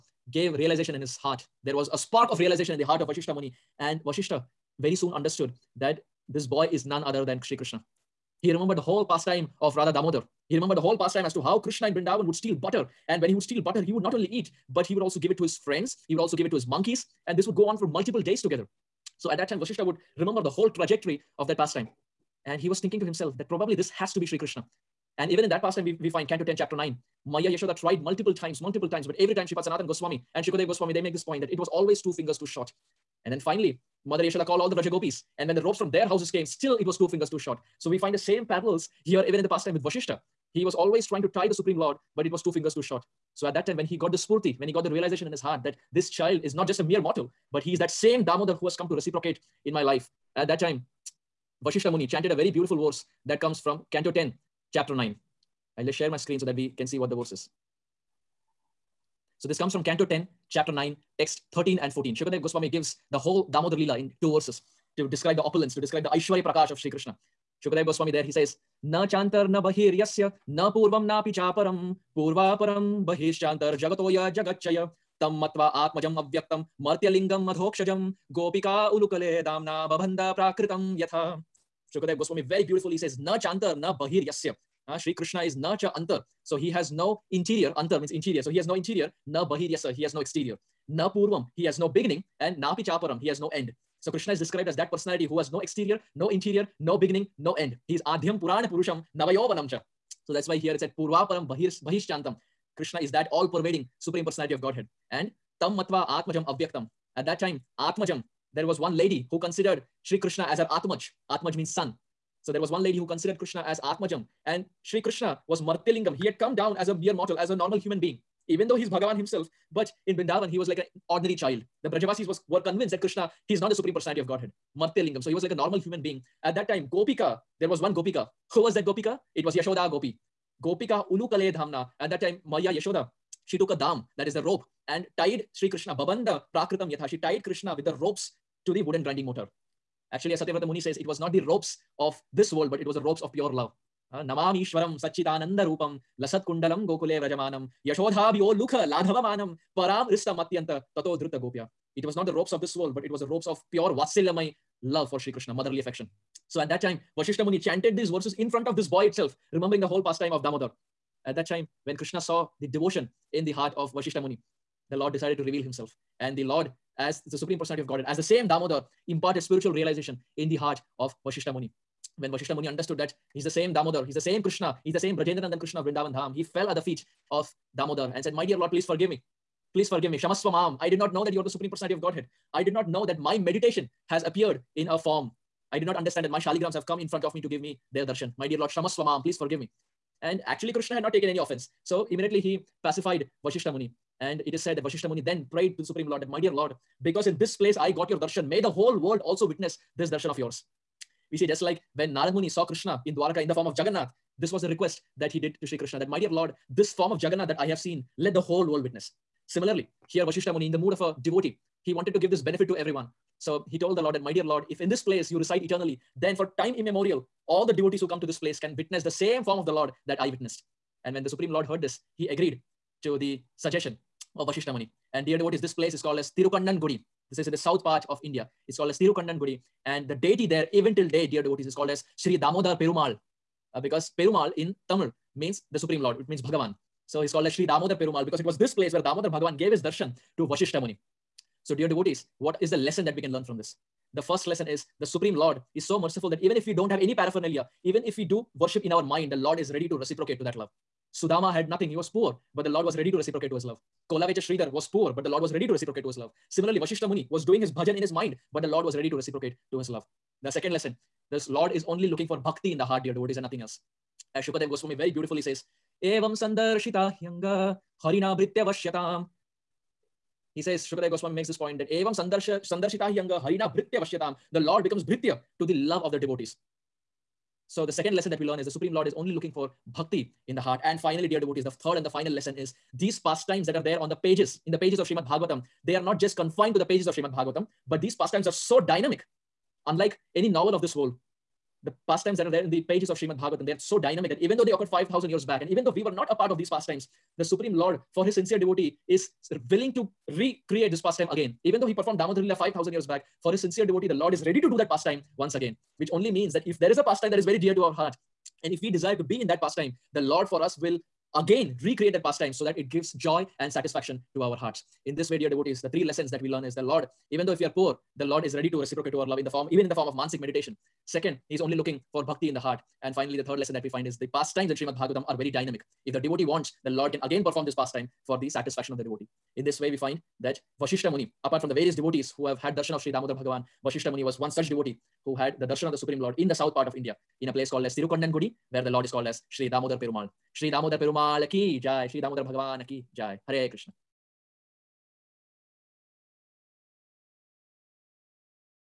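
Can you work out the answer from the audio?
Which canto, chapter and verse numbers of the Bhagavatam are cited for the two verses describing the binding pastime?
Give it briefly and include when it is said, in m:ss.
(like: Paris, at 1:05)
Canto 10, chapter 9, texts 13 and 14, at 1:00.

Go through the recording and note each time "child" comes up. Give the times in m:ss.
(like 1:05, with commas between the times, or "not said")
0:46, 2:01.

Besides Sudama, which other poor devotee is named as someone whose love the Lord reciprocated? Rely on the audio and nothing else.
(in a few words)
Kholavecha Sridhar.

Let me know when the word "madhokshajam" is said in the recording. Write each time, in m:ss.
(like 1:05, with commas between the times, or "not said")
1:17.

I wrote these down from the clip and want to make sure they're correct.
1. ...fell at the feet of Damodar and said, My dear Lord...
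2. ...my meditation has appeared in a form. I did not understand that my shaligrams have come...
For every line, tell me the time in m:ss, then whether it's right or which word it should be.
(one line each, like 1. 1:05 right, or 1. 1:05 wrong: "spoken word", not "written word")
1. 2:56 right
2. 3:03 right.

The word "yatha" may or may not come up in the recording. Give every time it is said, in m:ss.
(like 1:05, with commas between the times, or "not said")
1:20, 2:16.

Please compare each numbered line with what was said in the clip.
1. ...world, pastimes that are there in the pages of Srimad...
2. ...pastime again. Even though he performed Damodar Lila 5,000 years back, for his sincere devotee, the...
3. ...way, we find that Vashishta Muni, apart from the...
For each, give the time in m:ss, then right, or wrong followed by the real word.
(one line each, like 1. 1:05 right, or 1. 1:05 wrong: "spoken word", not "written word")
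1. 4:50 right
2. 5:01 right
3. 5:29 right.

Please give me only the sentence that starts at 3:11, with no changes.
So immediately he pacified Vashishta Muni.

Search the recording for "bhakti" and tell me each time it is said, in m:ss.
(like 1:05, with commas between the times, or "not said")
4:22, 4:39, 5:22.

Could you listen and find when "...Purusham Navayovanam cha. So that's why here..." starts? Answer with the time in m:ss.
1:38.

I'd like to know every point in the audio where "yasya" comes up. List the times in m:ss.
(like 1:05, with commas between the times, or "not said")
1:09, 1:24, 1:29.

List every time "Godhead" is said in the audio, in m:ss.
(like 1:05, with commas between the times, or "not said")
1:44, 2:04, 2:47, 3:02.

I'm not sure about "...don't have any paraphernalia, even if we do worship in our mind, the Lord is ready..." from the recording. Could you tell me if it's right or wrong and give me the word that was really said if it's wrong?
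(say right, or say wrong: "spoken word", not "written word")
right.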